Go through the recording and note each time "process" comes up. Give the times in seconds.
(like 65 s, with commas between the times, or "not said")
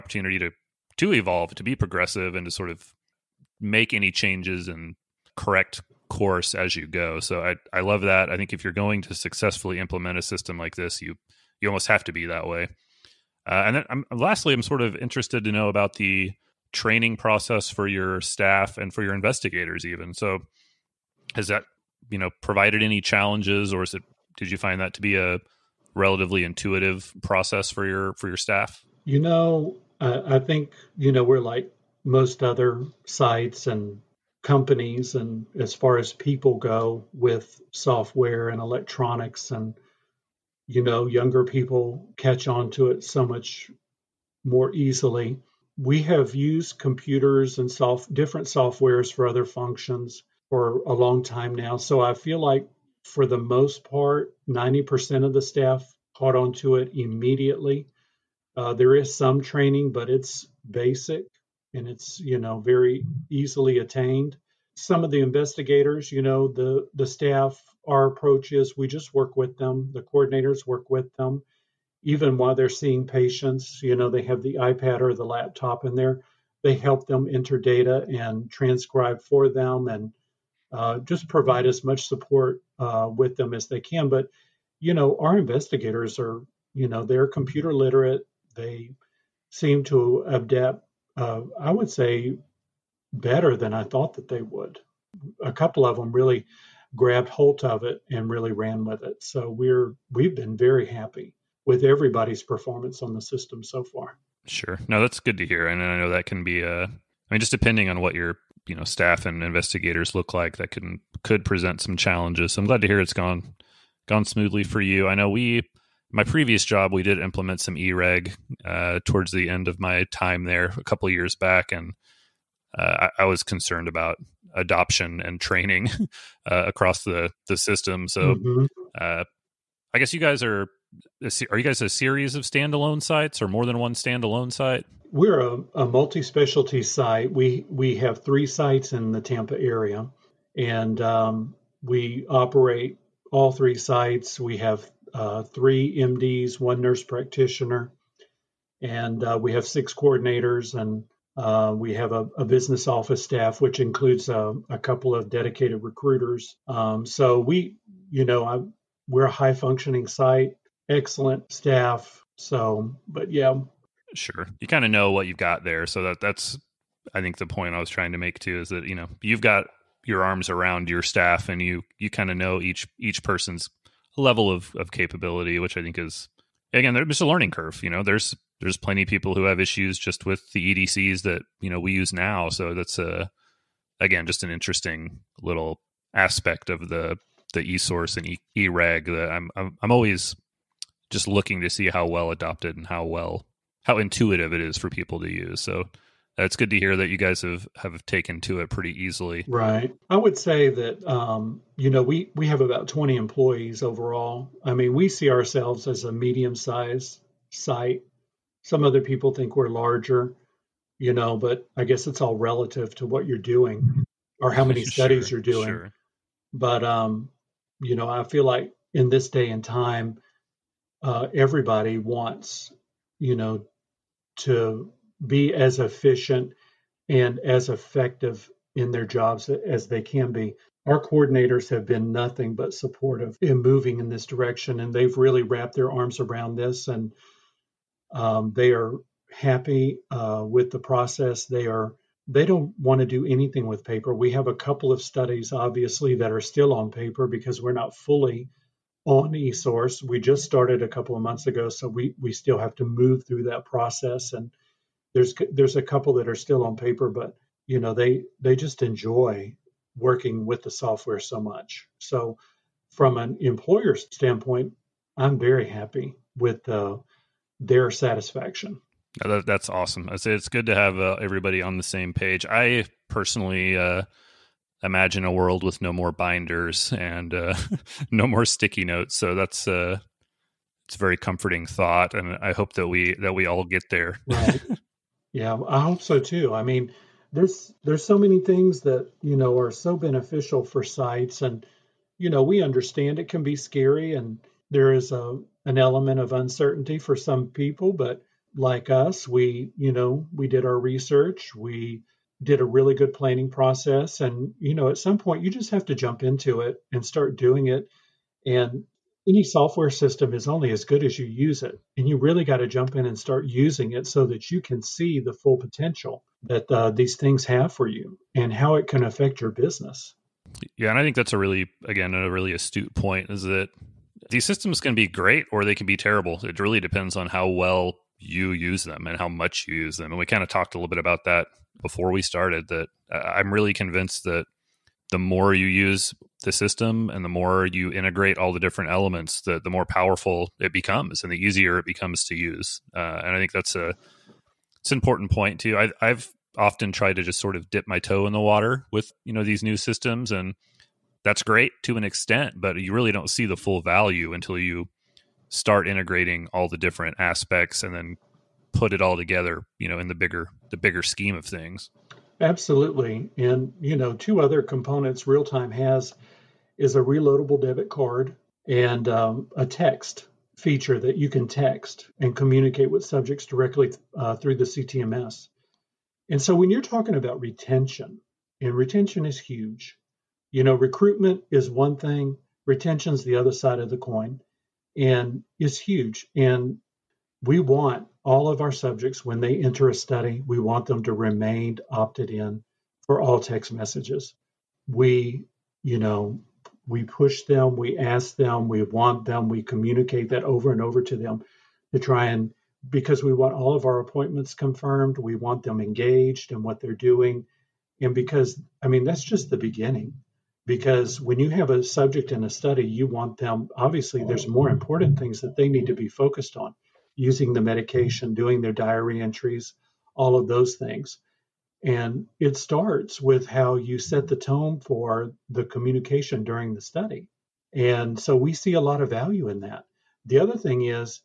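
17 s, 27 s, 240 s, 253 s, 303 s.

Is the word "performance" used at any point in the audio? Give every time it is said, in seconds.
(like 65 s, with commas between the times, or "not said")
102 s.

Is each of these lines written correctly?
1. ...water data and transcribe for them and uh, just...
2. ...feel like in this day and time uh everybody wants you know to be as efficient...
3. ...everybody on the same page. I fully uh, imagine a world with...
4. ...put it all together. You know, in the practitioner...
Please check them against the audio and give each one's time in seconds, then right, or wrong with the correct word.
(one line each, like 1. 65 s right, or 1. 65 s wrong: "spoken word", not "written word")
1. 77 s wrong: "enter", not "water"
2. 218 s right
3. 271 s wrong: "personally", not "fully"
4. 358 s wrong: "bigger", not "practitioner".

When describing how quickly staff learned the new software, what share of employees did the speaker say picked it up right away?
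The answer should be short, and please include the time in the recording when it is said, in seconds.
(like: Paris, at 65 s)
90%, at 54 s.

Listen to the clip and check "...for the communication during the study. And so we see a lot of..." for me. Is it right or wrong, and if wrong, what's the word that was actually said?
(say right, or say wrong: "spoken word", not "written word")
right.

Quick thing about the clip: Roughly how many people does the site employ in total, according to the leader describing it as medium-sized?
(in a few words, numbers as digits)
20.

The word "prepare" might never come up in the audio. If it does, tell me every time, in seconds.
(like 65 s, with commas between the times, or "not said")
not said.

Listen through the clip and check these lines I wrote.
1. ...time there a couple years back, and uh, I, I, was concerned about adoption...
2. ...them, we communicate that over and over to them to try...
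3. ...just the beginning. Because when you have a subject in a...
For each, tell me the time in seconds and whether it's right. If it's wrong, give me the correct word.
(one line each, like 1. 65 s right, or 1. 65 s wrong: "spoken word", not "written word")
1. 120 s right
2. 399 s right
3. 409 s right.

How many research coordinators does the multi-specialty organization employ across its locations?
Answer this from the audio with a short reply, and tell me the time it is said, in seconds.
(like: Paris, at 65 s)
6, at 149 s.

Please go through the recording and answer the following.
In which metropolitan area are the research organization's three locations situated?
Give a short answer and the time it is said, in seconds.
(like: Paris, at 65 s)
Tampa, at 139 s.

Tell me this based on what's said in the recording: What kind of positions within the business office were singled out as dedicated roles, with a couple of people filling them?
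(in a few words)
recruiters.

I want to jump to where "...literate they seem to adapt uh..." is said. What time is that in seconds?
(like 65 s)
87 s.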